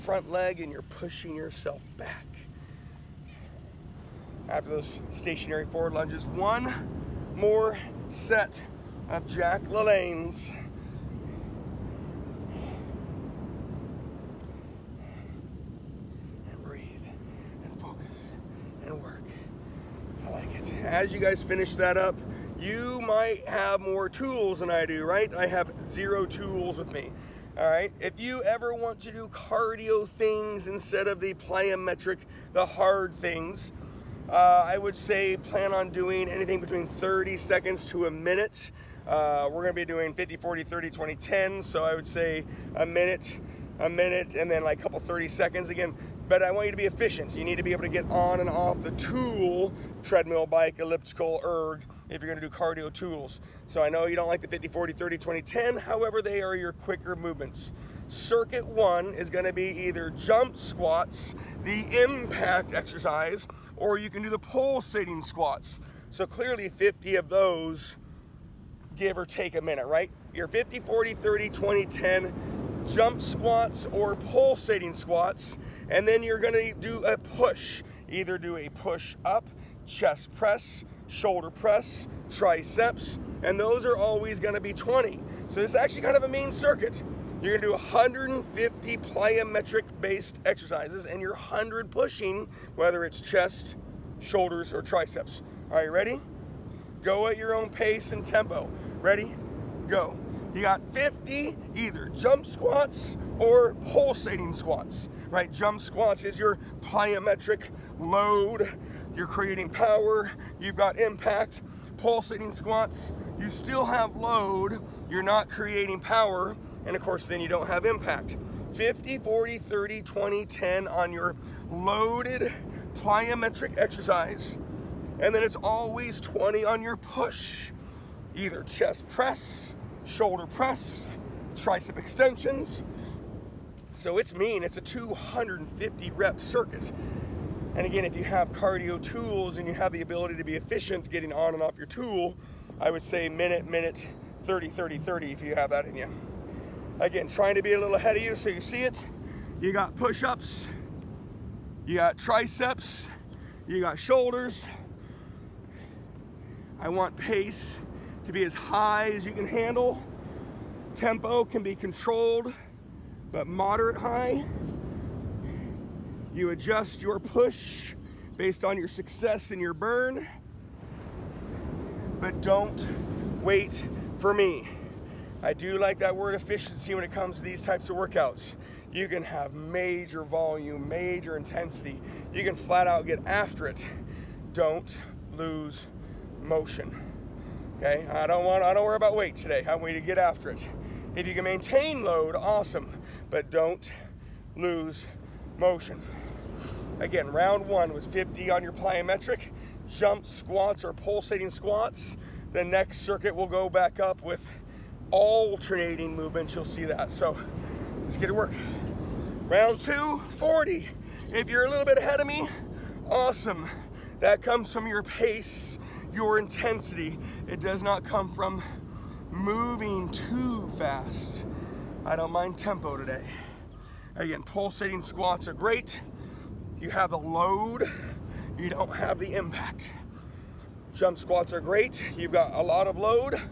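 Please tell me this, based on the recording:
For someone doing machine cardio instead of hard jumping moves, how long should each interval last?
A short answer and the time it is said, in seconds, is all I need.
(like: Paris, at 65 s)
30 seconds to a minute, at 36 s.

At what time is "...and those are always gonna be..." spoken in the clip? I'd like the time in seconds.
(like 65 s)
83 s.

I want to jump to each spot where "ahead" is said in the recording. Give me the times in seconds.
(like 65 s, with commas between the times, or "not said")
147 s, 211 s.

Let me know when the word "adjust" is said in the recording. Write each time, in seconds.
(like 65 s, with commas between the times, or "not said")
166 s.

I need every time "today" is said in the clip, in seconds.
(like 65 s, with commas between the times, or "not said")
189 s, 222 s.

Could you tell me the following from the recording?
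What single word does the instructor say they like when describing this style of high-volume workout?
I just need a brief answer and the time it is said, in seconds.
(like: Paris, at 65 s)
Efficiency, at 176 s.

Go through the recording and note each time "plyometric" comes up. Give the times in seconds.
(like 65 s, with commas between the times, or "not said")
31 s, 88 s, 106 s, 122 s, 198 s.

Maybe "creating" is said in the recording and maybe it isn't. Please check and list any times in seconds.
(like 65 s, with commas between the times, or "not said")
109 s, 115 s.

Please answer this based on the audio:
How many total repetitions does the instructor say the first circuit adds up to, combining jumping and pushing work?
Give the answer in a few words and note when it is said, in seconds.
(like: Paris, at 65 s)
250, at 134 s.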